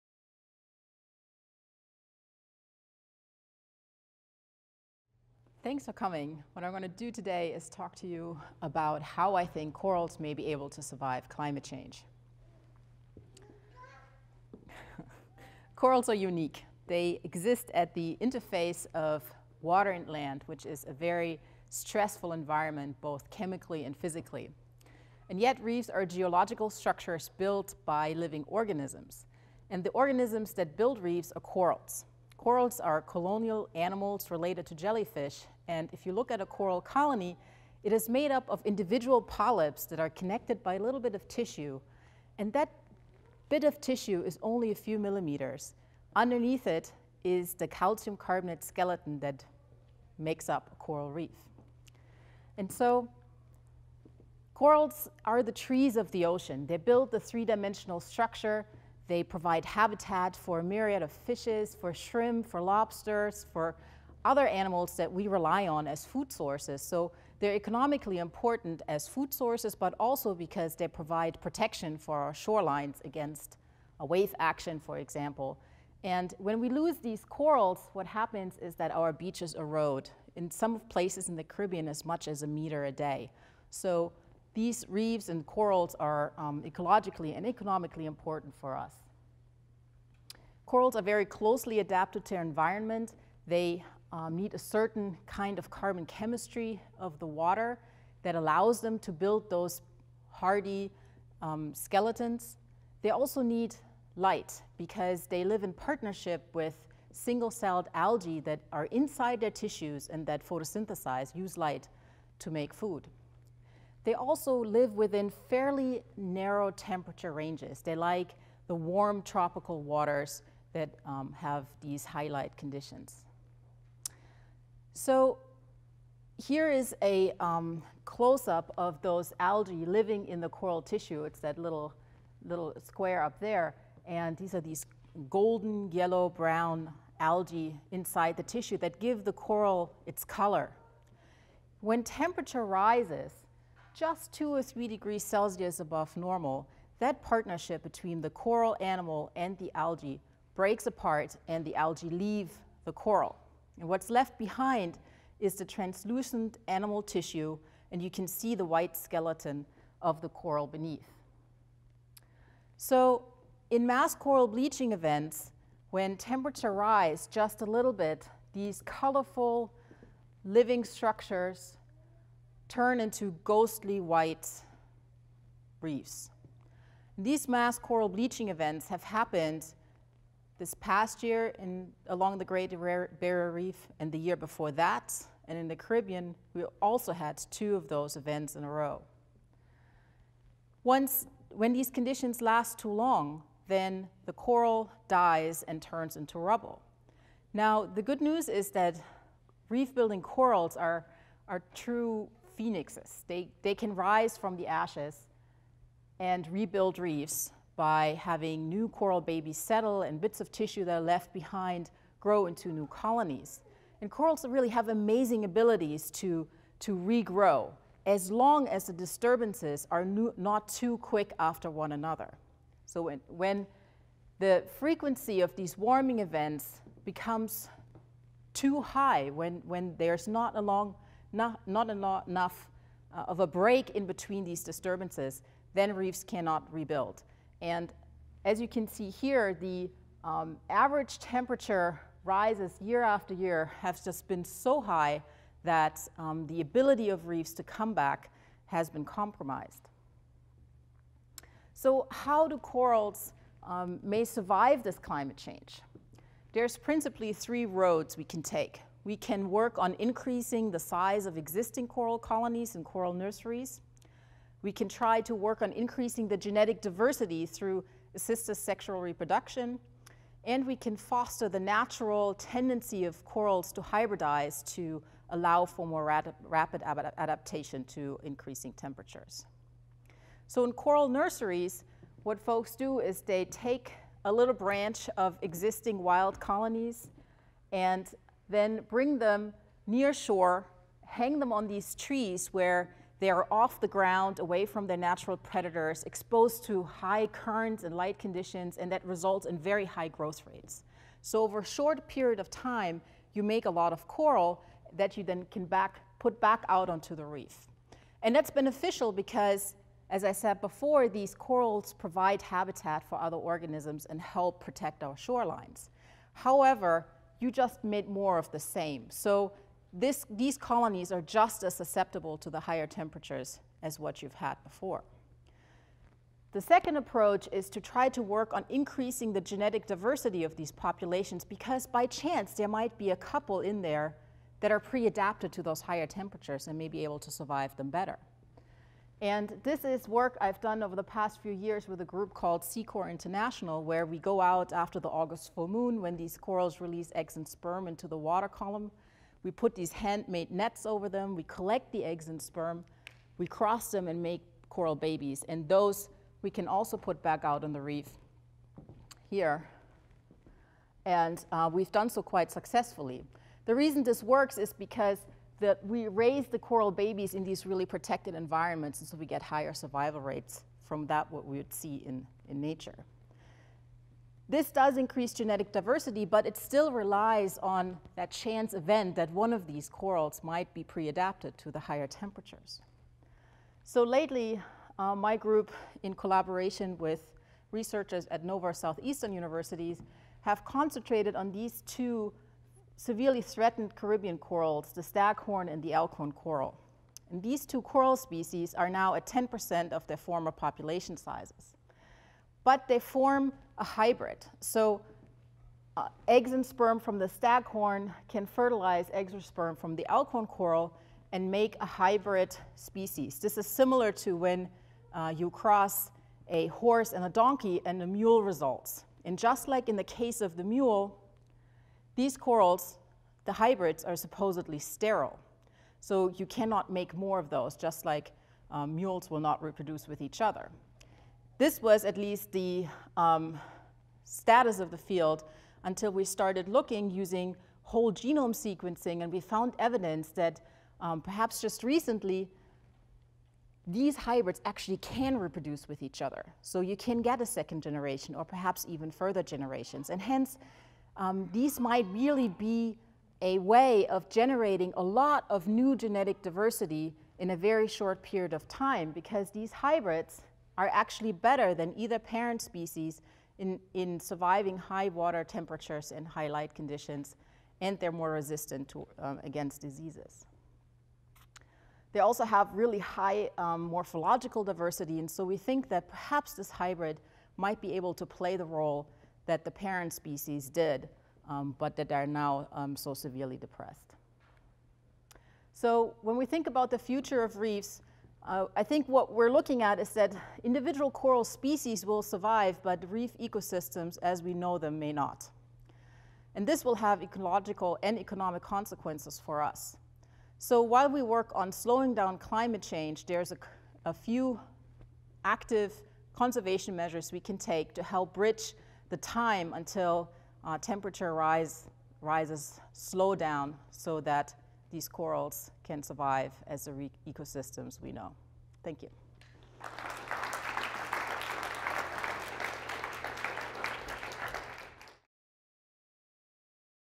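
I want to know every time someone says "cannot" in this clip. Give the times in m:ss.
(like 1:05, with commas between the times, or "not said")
3:56, 7:06.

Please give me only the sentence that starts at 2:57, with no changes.
These mass coral bleaching events have happened this past year in, along the Great Barrier Reef and the year before that.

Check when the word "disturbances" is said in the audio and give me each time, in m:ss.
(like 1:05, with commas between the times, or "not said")
3:38, 3:54.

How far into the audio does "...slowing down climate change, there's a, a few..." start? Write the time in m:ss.
8:21.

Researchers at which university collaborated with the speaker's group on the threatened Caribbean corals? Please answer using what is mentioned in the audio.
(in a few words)
Nova Southeastern.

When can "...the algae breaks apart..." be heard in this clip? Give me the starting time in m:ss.
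2:29.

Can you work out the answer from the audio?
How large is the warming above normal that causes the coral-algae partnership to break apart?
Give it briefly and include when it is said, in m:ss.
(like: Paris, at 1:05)
2 or 3 degrees Celsius, at 2:24.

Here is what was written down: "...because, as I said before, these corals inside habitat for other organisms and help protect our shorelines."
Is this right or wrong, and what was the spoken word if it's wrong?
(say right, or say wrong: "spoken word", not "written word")
wrong: "provide", not "inside".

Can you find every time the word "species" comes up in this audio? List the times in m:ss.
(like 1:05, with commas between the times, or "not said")
6:38, 6:52, 7:42, 8:00, 8:11.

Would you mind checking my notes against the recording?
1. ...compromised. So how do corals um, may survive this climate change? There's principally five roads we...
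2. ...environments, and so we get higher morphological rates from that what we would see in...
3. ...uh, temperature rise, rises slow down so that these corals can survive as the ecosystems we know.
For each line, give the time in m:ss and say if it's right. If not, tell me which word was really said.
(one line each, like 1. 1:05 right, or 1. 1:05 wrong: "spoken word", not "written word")
1. 4:09 wrong: "three", not "five"
2. 6:08 wrong: "survival", not "morphological"
3. 8:30 right.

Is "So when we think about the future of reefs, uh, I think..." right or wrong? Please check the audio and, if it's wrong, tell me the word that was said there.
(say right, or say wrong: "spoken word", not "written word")
right.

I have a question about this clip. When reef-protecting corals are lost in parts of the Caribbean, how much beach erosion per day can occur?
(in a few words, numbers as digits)
1 meter a day.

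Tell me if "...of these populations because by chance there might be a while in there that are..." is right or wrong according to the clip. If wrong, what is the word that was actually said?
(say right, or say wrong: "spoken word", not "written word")
wrong: "couple", not "while".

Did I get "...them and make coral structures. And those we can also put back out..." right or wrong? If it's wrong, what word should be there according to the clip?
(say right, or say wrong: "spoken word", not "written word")
wrong: "babies", not "structures".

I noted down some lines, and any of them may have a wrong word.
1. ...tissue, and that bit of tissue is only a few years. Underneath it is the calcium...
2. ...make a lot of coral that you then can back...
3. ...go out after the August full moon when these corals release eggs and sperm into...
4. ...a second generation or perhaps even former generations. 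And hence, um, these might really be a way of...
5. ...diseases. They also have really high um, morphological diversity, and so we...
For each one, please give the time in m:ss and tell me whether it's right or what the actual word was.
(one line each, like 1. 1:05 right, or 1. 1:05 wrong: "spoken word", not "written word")
1. 0:41 wrong: "millimeters", not "years"
2. 5:03 right
3. 5:44 right
4. 7:27 wrong: "further", not "former"
5. 7:49 right.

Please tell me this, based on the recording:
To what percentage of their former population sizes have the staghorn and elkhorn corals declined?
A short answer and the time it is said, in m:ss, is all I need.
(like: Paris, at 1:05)
10%, at 6:39.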